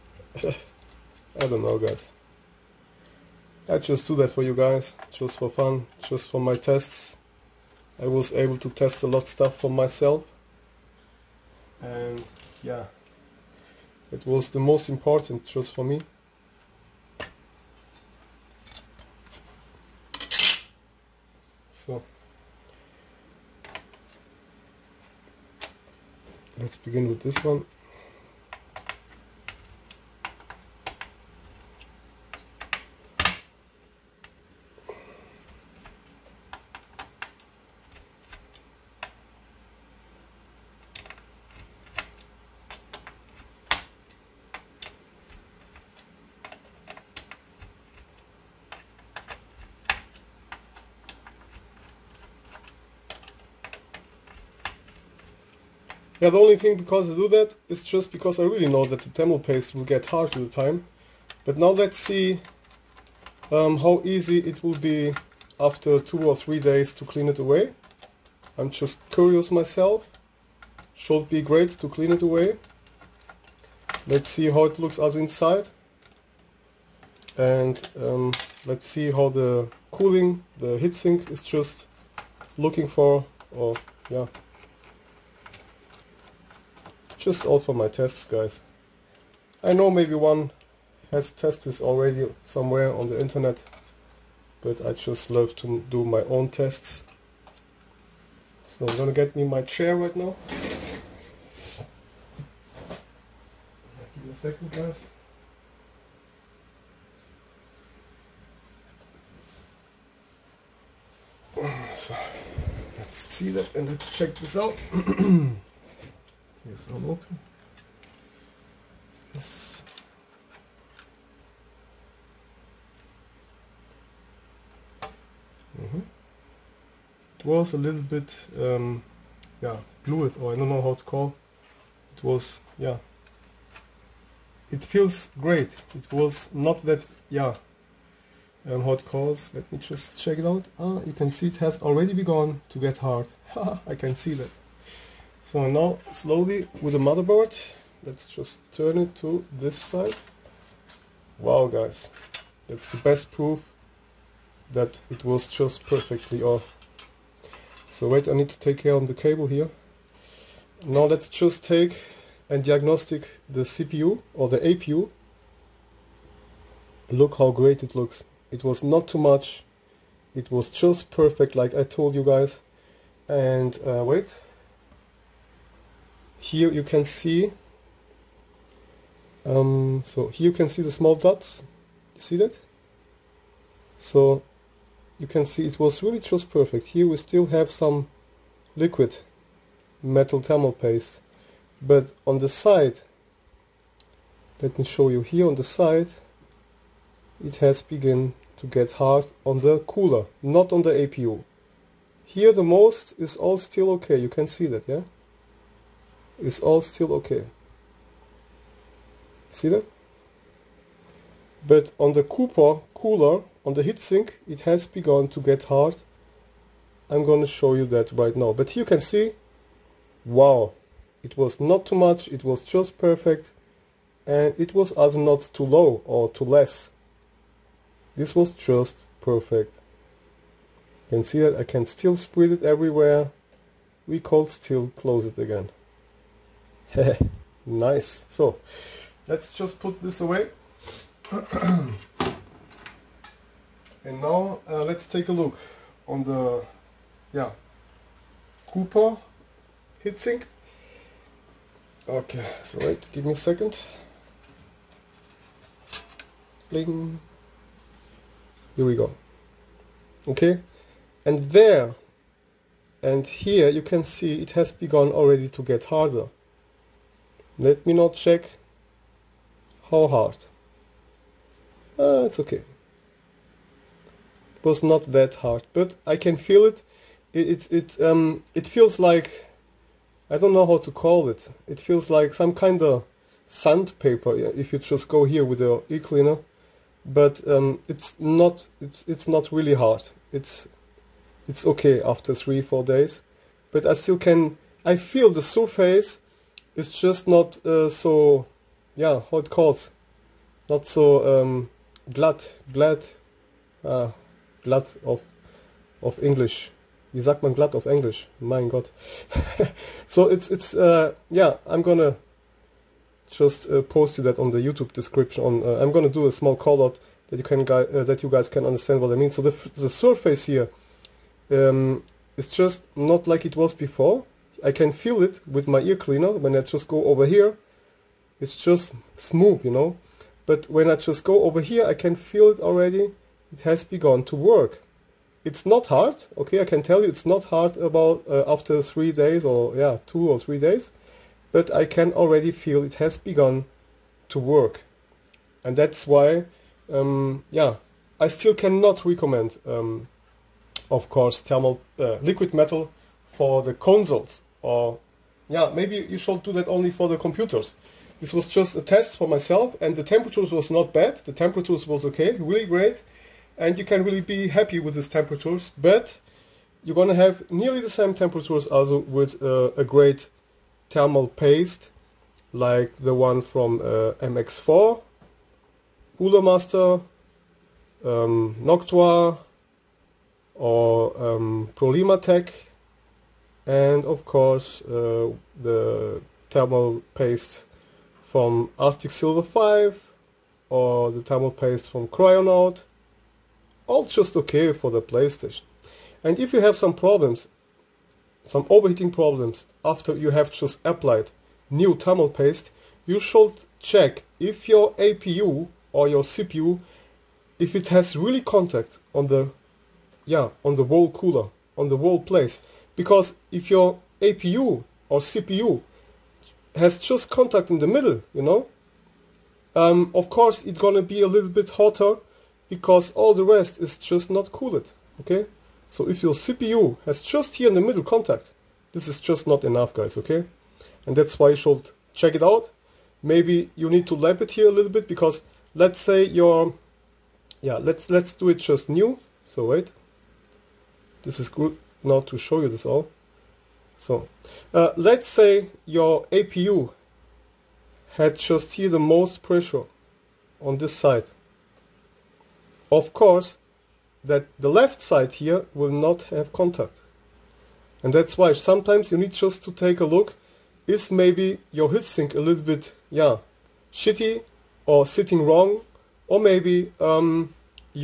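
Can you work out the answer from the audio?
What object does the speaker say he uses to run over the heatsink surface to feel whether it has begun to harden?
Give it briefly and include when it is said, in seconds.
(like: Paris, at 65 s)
ear cleaner, at 325 s.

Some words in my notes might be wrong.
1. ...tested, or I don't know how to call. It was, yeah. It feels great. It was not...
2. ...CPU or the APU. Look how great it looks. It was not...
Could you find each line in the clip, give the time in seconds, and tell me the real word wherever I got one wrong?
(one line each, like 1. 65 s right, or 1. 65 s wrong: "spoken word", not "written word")
1. 130 s wrong: "glued", not "tested"
2. 163 s right.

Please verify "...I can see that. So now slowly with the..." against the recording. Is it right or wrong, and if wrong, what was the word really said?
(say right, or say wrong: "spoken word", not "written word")
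right.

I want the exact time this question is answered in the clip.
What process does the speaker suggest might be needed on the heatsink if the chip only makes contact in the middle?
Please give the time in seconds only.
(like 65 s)
434 s.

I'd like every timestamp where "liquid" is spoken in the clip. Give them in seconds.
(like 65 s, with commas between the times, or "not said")
188 s, 352 s.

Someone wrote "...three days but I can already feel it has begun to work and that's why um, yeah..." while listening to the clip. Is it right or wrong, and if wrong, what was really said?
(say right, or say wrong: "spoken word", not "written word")
right.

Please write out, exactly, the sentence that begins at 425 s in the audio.
So if your CPU has just here in the middle contact, this is just not enough guys, okay?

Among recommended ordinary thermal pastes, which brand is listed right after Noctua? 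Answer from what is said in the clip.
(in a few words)
Prolimatech.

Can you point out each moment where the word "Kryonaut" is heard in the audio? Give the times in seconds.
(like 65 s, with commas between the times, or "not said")
392 s.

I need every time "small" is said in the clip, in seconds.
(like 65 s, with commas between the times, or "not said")
180 s, 316 s.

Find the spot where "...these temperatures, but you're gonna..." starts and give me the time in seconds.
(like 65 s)
364 s.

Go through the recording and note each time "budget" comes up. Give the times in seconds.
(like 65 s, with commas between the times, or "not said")
not said.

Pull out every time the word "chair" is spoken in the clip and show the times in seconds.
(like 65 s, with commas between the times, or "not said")
99 s.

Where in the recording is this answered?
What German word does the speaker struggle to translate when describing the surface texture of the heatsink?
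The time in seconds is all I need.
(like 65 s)
307 s.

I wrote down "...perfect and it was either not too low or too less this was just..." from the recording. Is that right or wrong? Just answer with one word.
right.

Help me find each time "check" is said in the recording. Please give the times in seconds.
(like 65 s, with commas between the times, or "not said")
114 s, 140 s, 268 s, 403 s, 432 s.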